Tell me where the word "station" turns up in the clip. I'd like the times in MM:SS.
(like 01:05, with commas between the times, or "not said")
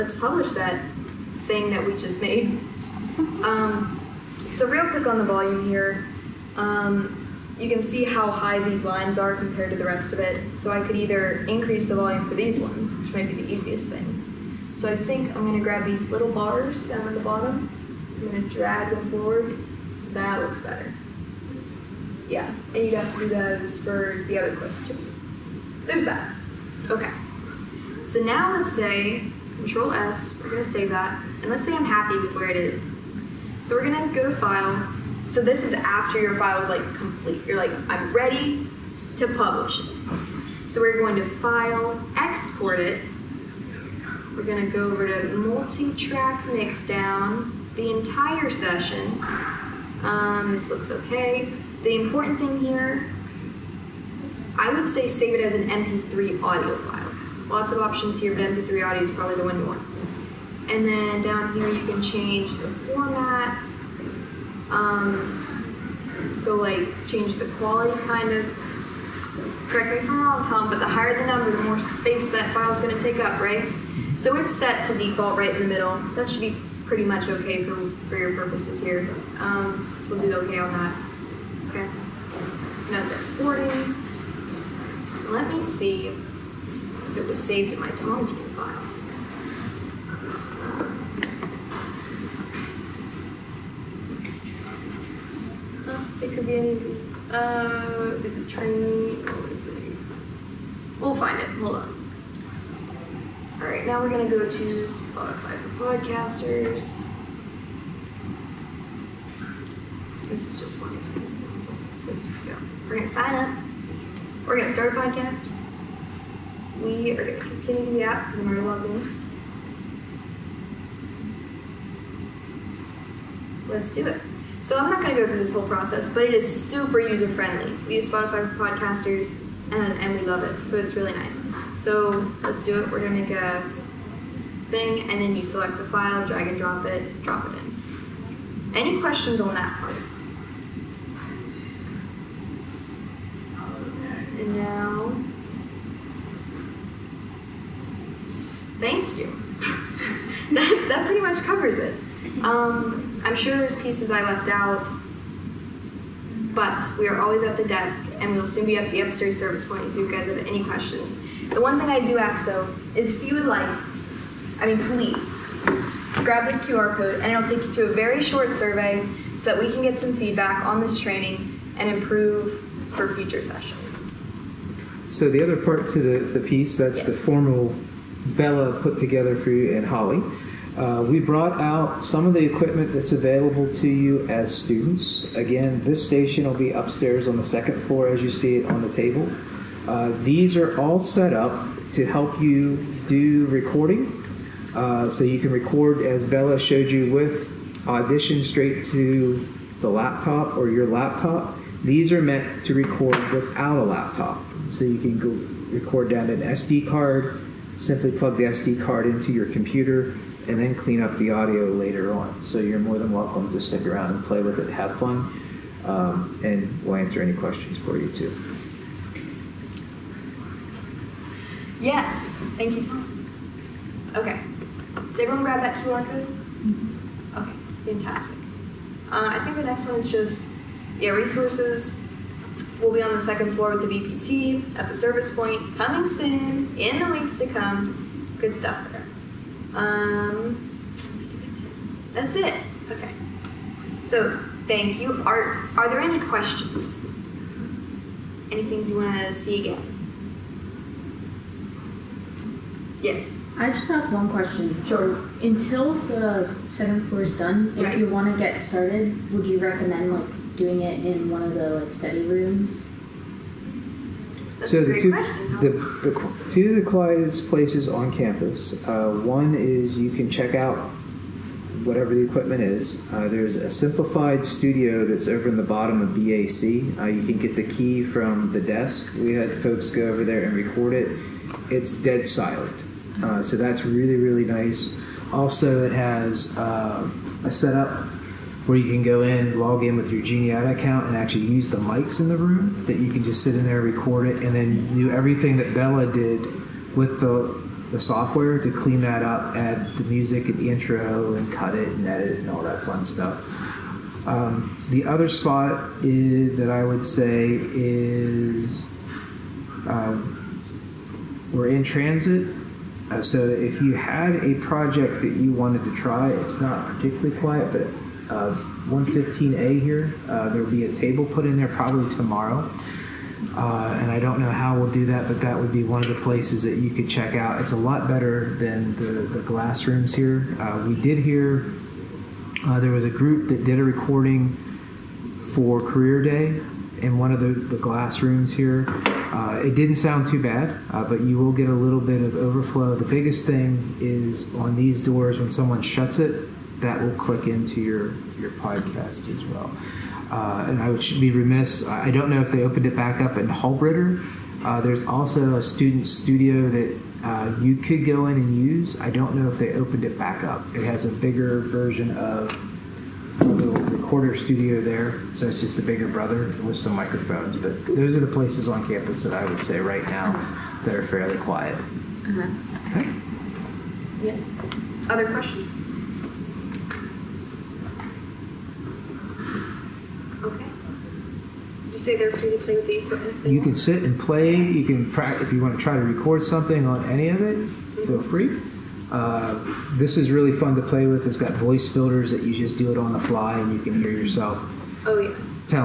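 03:06.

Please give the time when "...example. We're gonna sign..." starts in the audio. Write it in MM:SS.
01:50.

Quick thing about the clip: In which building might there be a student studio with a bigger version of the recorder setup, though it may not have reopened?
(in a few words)
Halbritter.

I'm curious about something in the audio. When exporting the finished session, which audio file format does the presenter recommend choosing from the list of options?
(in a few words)
MP3.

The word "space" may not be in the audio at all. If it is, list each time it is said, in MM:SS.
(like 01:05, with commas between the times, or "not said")
01:11.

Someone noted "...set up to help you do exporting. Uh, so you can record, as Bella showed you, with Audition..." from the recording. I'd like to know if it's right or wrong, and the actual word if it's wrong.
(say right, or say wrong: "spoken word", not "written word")
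wrong: "recording", not "exporting".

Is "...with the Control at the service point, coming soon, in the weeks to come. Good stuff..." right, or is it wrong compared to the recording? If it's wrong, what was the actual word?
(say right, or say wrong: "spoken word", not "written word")
wrong: "BPT", not "Control".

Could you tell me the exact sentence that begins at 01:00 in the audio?
And then down here you can change the format.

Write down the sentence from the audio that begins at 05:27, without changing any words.
It's a lot better than the, the glass rooms here.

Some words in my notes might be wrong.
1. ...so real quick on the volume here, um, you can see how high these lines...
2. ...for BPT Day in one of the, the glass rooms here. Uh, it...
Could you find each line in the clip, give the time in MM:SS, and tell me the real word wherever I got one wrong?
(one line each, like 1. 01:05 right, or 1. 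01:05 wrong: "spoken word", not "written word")
1. 00:04 right
2. 05:35 wrong: "Career", not "BPT".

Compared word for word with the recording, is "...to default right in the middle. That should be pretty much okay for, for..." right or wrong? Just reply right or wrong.
right.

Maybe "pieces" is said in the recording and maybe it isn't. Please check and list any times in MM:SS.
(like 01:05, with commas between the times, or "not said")
02:33, 02:56.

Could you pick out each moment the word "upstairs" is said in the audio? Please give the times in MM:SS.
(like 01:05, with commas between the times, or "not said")
02:39, 03:06.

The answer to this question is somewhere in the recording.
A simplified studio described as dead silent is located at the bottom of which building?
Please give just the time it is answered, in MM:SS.
04:36.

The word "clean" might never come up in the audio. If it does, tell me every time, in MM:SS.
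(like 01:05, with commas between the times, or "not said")
03:30, 04:58.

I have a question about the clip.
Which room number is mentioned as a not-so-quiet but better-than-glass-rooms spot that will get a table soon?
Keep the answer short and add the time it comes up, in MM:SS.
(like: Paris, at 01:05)
115A, at 05:18.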